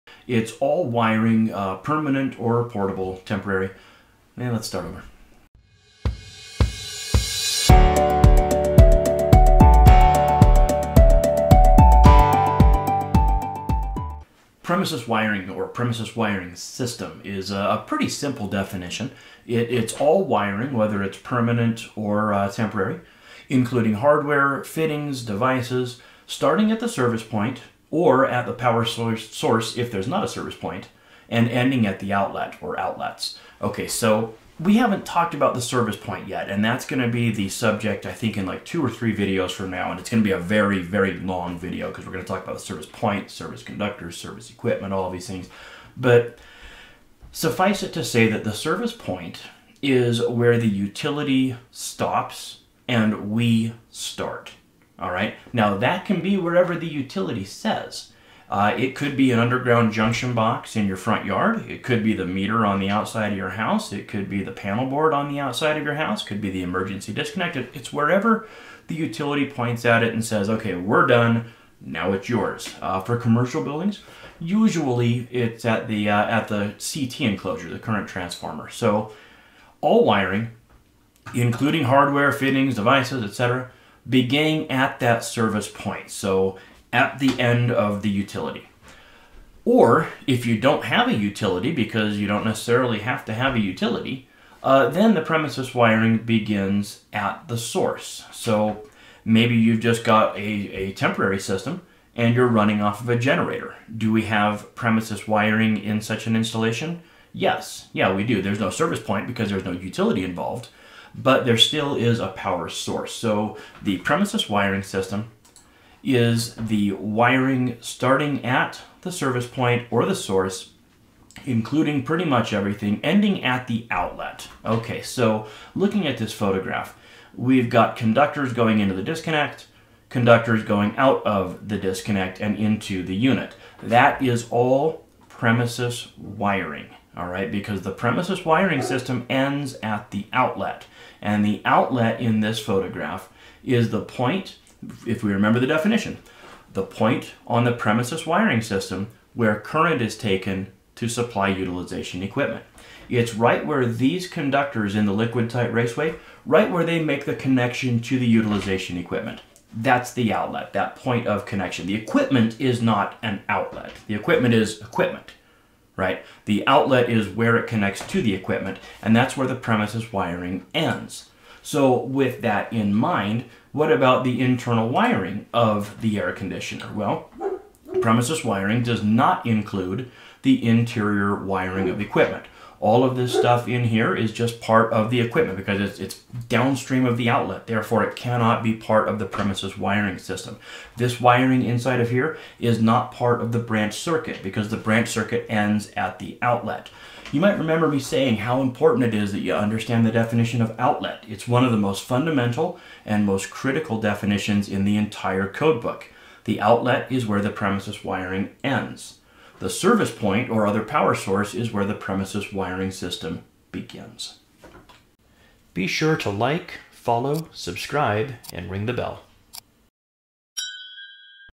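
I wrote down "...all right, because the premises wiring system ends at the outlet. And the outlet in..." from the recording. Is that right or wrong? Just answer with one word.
right.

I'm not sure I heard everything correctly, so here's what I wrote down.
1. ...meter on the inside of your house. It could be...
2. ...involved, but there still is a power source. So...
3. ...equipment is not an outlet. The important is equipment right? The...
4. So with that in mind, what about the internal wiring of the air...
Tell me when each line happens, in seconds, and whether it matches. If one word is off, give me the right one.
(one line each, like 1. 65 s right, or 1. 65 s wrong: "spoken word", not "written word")
1. 62 s wrong: "outside", not "inside"
2. 110 s right
3. 161 s wrong: "equipment", not "important"
4. 171 s right.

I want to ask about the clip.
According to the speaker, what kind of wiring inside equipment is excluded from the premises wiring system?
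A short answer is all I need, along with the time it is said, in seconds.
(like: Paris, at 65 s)
interior wiring, at 180 s.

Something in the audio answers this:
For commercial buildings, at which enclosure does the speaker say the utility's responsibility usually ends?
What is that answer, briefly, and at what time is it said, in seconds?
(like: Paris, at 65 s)
CT enclosure, at 76 s.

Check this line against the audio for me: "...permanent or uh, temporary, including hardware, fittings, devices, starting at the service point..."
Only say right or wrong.
right.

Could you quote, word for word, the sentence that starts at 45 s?
But suffice it to say that the service point is where the utility stops and we start.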